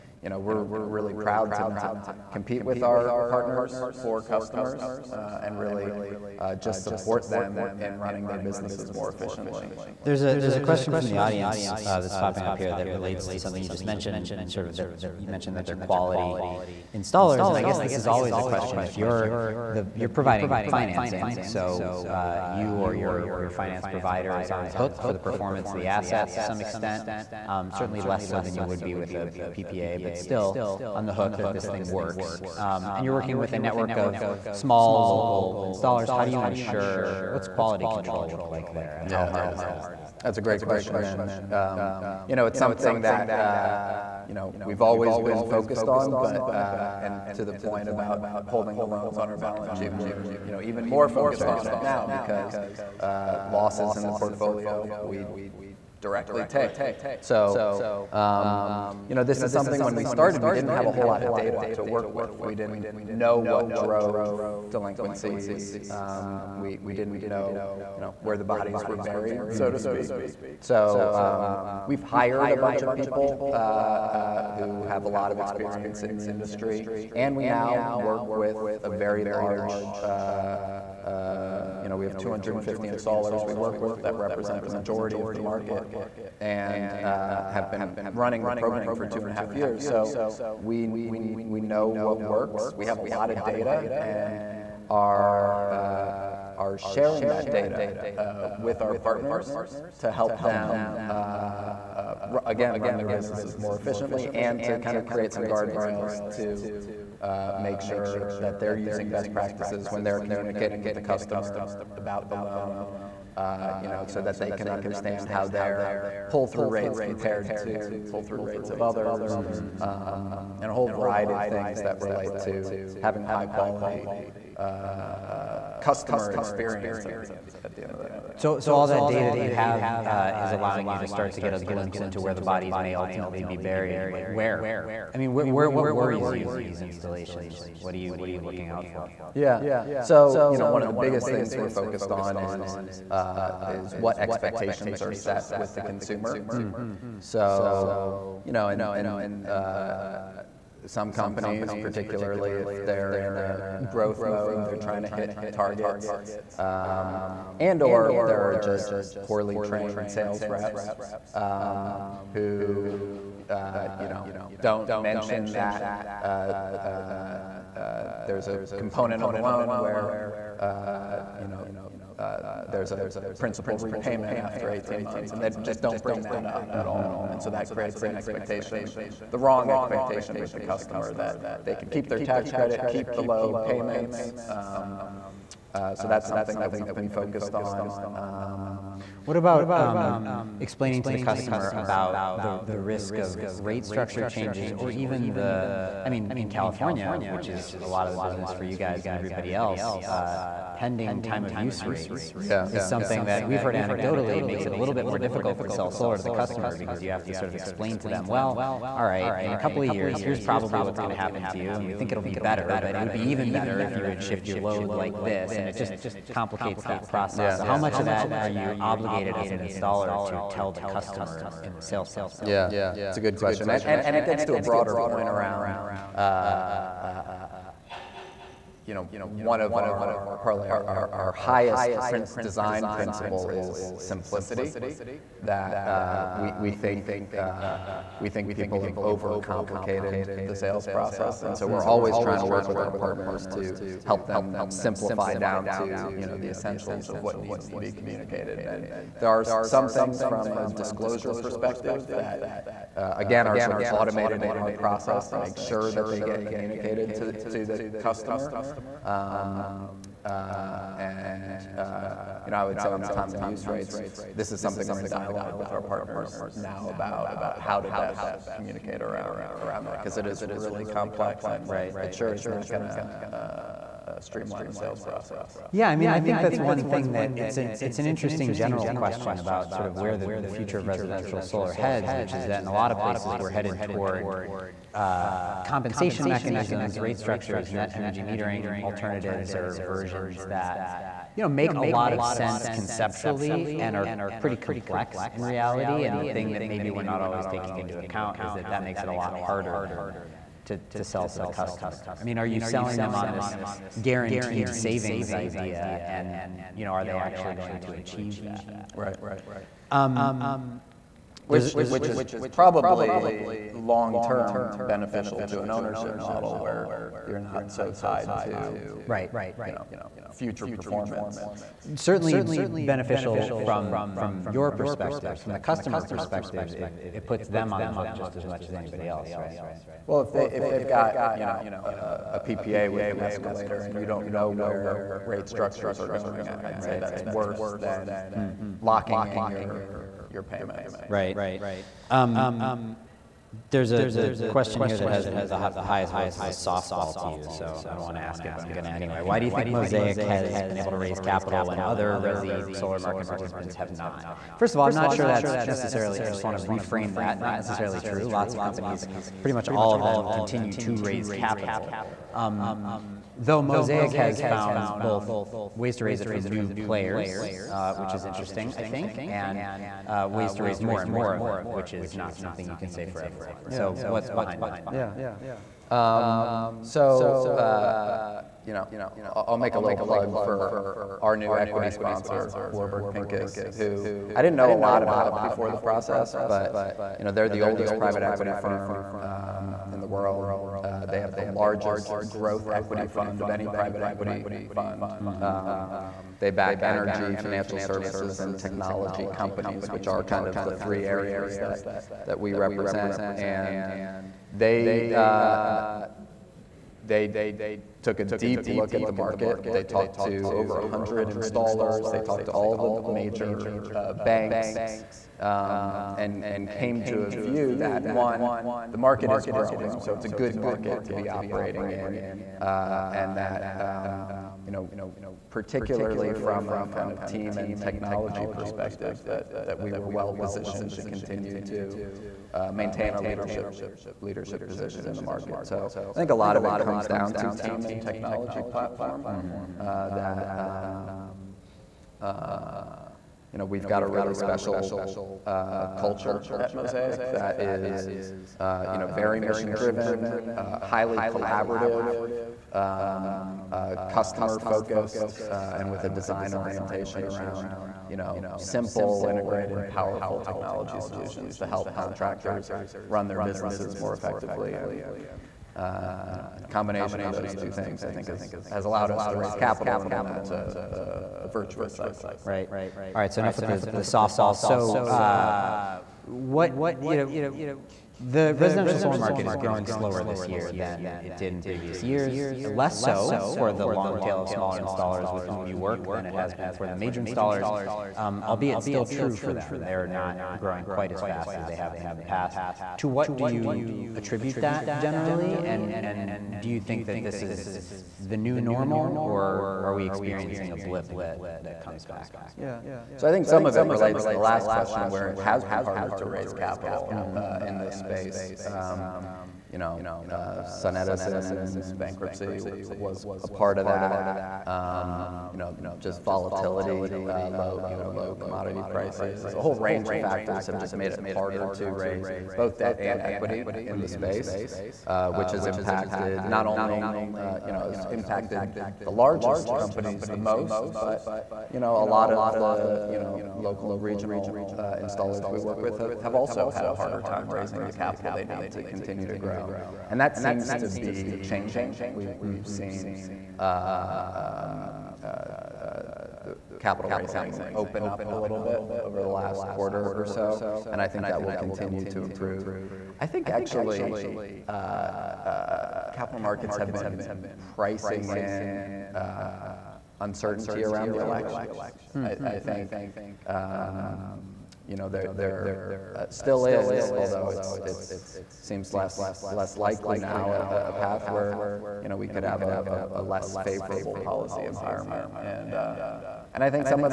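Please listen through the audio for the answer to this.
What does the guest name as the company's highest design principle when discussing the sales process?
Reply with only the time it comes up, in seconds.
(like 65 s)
233 s.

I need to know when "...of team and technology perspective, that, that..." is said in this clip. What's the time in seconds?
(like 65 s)
427 s.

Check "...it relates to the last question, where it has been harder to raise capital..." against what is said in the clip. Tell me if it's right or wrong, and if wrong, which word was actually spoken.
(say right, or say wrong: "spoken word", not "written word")
right.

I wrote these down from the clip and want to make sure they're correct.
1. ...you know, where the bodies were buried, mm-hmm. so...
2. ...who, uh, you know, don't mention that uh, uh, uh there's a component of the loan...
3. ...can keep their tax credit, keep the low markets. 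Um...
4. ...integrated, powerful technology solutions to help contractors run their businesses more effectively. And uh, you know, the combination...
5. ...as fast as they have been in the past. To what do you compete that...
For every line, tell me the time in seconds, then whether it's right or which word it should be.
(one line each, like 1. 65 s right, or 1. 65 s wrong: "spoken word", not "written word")
1. 67 s right
2. 162 s right
3. 181 s wrong: "payments", not "markets"
4. 459 s right
5. 491 s wrong: "attribute", not "compete".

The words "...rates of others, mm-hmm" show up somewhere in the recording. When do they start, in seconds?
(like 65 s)
118 s.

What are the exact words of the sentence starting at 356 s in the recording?
I just want to reframe that.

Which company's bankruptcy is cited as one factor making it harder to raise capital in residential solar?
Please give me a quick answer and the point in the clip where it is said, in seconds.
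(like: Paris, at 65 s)
SunEdison, at 510 s.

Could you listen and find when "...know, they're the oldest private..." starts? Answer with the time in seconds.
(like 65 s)
387 s.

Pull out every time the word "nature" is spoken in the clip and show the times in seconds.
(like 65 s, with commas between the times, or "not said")
not said.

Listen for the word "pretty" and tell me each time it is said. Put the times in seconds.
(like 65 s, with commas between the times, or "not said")
294 s, 359 s.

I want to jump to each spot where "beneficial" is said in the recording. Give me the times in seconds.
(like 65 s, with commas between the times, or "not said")
314 s, 322 s.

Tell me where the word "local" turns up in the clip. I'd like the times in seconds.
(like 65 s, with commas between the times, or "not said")
35 s, 533 s.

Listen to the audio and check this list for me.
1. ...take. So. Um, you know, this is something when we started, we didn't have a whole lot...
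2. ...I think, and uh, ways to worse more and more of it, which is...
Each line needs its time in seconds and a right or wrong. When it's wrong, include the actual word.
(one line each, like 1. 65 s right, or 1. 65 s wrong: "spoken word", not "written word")
1. 56 s right
2. 368 s wrong: "raise", not "worse".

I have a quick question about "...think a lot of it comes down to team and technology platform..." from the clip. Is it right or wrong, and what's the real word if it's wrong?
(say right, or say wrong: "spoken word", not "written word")
right.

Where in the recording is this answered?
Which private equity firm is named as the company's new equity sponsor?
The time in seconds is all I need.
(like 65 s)
382 s.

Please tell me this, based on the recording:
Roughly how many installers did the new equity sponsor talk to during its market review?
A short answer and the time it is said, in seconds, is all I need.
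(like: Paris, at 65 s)
over 100, at 410 s.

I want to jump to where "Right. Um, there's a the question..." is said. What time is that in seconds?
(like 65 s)
341 s.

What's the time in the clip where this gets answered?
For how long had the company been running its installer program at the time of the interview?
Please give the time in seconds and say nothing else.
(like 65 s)
89 s.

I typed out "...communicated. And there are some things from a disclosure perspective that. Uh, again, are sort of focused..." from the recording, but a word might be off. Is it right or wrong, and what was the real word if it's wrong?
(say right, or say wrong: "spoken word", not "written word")
wrong: "automated", not "focused".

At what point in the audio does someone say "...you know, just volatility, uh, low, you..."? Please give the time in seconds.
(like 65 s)
515 s.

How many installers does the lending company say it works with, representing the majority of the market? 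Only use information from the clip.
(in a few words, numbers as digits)
250.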